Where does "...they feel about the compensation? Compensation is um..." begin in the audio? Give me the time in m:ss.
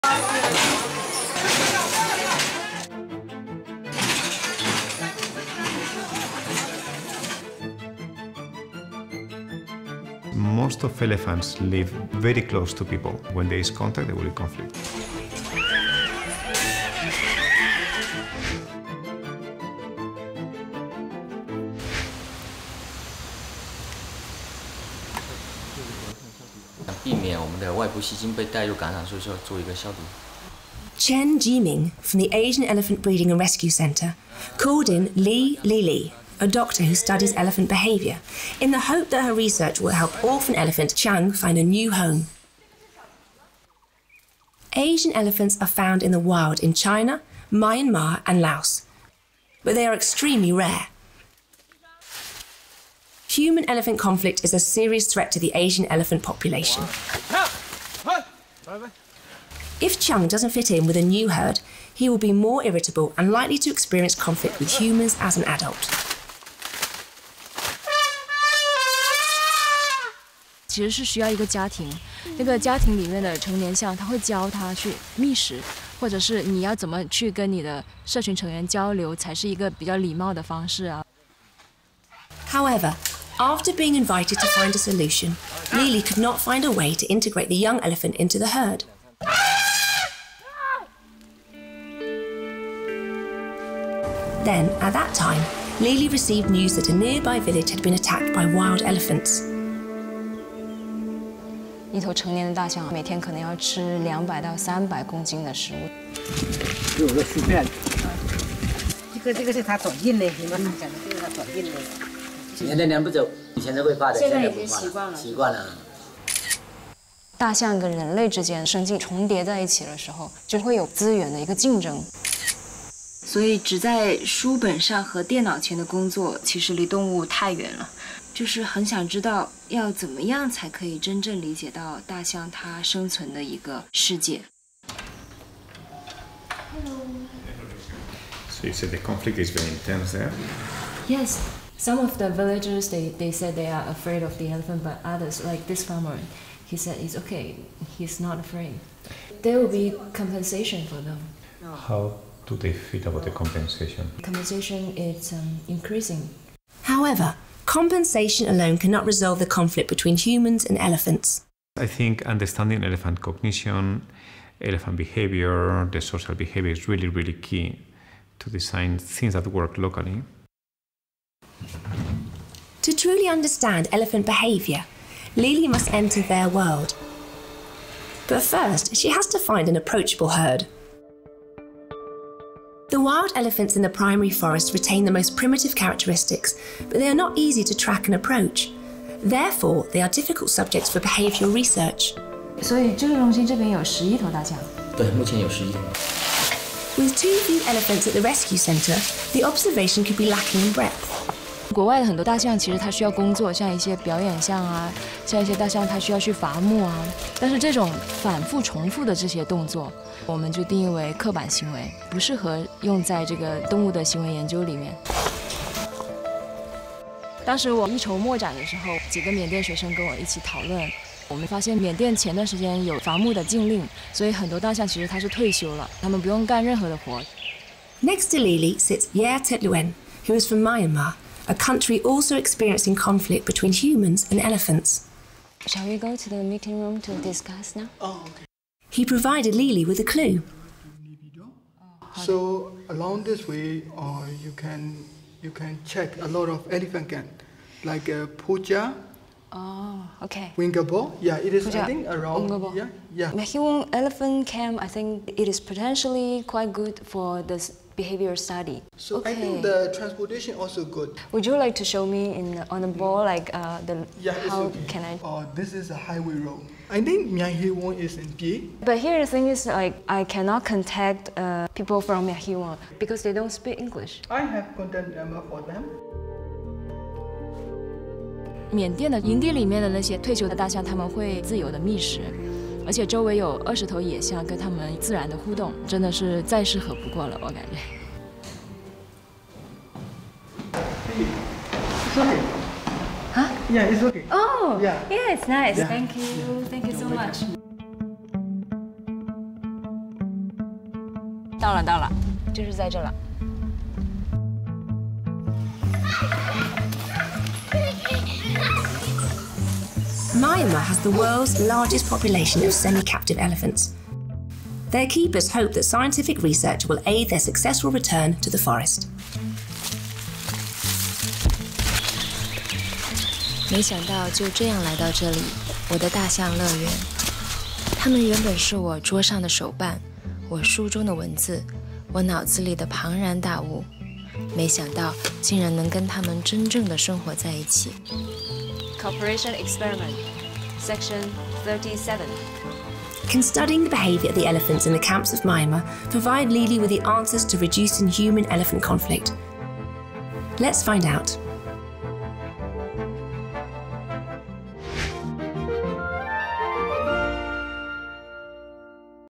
2:32.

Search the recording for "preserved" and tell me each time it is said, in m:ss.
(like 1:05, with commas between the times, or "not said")
not said.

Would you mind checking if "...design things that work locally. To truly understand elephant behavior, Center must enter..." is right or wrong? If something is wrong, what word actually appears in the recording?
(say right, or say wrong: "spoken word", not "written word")
wrong: "Lily", not "Center".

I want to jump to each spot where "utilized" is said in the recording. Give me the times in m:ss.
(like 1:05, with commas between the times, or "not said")
not said.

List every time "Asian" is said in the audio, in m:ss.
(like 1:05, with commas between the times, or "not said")
0:32, 0:44, 0:55.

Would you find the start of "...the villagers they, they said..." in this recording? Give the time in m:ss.
2:22.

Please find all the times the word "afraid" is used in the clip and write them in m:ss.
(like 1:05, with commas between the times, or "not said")
2:23, 2:28.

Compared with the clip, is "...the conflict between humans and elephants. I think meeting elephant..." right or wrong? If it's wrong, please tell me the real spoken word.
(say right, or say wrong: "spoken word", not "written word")
wrong: "understanding", not "meeting".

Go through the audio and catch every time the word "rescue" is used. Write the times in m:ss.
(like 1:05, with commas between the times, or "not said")
0:33, 3:18.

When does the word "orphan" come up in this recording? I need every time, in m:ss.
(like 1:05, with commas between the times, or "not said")
0:40.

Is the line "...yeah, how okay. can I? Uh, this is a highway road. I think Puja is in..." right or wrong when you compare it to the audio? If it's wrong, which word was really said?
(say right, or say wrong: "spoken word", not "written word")
wrong: "Myeonghiwon", not "Puja".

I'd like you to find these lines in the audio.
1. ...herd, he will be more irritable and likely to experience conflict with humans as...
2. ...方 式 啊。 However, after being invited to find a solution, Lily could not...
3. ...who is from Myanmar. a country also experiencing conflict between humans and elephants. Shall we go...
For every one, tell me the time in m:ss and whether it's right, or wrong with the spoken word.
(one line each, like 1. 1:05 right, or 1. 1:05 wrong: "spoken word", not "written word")
1. 1:01 right
2. 1:20 right
3. 3:50 right.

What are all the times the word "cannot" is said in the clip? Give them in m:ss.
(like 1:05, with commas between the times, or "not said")
2:38, 4:30.